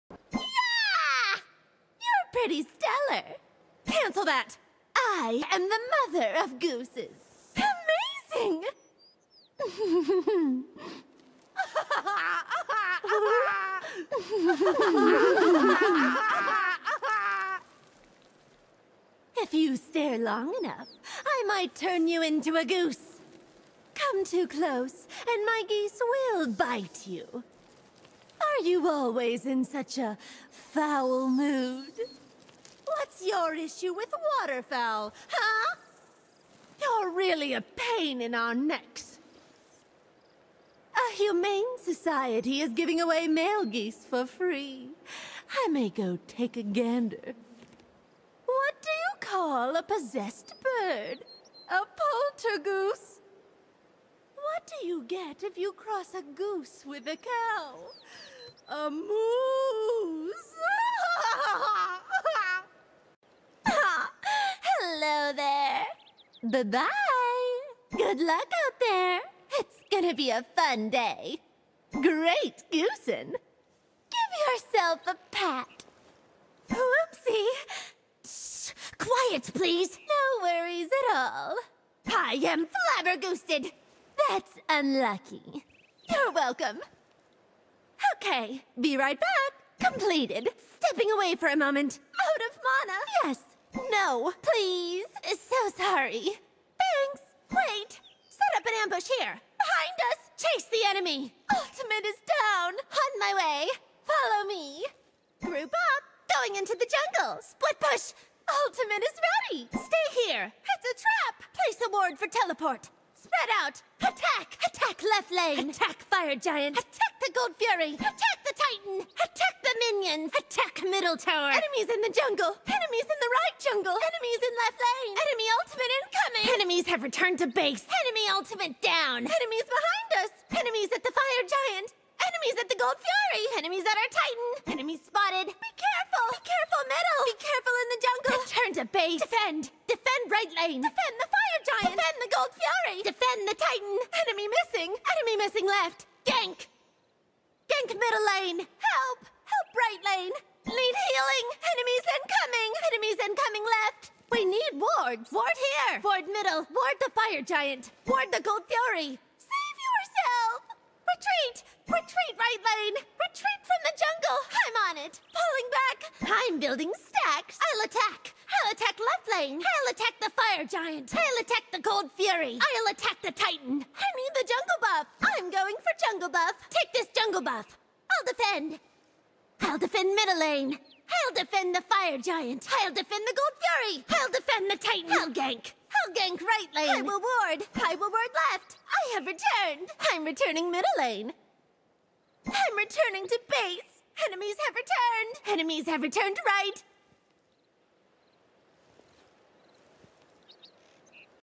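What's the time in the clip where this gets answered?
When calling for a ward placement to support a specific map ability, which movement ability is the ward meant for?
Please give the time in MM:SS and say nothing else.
01:52.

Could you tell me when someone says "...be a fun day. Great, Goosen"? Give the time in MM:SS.
01:10.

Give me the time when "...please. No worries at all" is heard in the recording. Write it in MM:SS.
01:19.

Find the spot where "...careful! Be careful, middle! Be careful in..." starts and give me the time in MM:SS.
02:15.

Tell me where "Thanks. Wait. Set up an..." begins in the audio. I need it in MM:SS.
01:36.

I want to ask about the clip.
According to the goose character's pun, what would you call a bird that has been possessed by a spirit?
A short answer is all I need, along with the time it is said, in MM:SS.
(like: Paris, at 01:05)
Poltergoose, at 00:51.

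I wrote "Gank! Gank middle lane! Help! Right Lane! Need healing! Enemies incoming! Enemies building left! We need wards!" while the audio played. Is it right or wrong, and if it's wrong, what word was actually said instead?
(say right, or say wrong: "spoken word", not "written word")
wrong: "incoming", not "building".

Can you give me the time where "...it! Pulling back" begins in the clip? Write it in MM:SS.
02:45.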